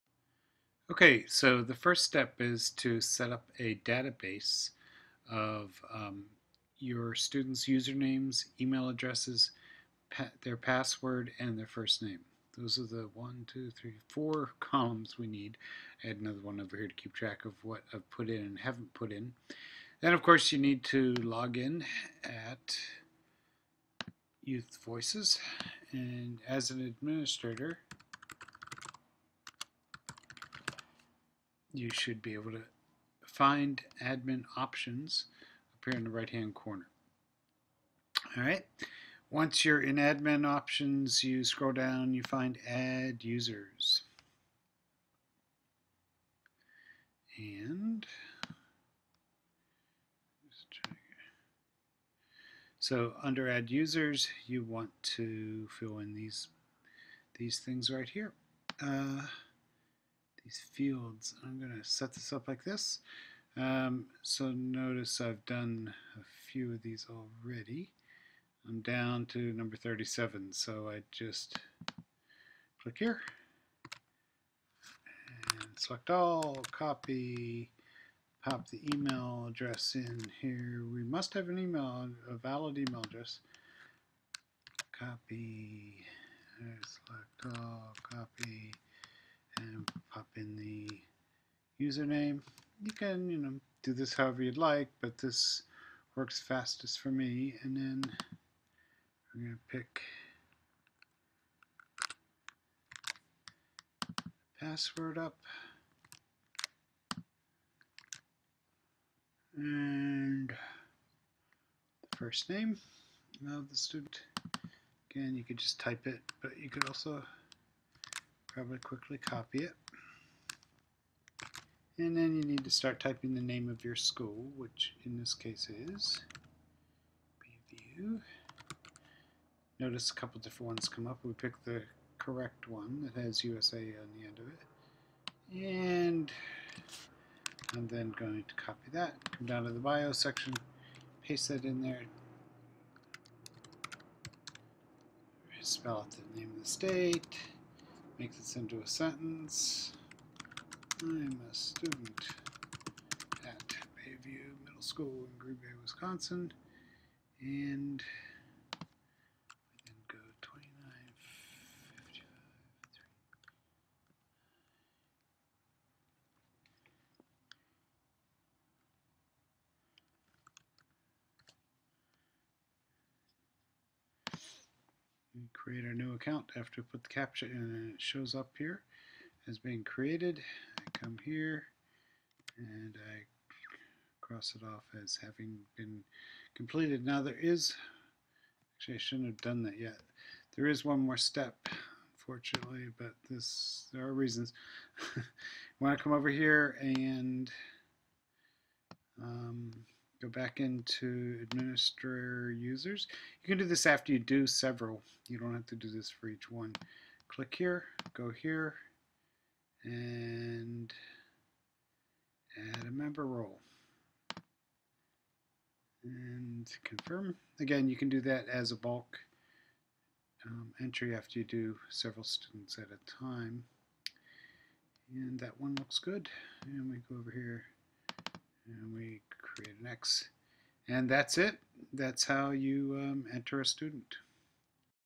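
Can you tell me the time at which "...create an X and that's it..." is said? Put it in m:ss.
3:49.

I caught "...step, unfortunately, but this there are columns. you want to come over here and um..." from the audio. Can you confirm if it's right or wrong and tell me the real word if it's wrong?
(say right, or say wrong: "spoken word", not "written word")
wrong: "reasons", not "columns".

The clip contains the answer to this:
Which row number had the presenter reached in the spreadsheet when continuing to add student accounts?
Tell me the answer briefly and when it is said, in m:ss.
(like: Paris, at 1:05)
37, at 1:09.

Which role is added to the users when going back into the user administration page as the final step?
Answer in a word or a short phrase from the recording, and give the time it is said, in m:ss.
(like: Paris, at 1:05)
member role, at 3:32.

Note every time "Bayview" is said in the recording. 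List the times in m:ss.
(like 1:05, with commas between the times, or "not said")
2:07, 2:33.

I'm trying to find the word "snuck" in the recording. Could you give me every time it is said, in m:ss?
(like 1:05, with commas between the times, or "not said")
not said.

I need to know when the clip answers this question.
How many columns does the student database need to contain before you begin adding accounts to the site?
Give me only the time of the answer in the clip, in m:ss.
0:14.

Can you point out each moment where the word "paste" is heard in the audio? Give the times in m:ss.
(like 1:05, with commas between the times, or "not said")
2:21.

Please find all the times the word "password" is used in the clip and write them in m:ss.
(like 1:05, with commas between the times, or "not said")
0:10, 1:44.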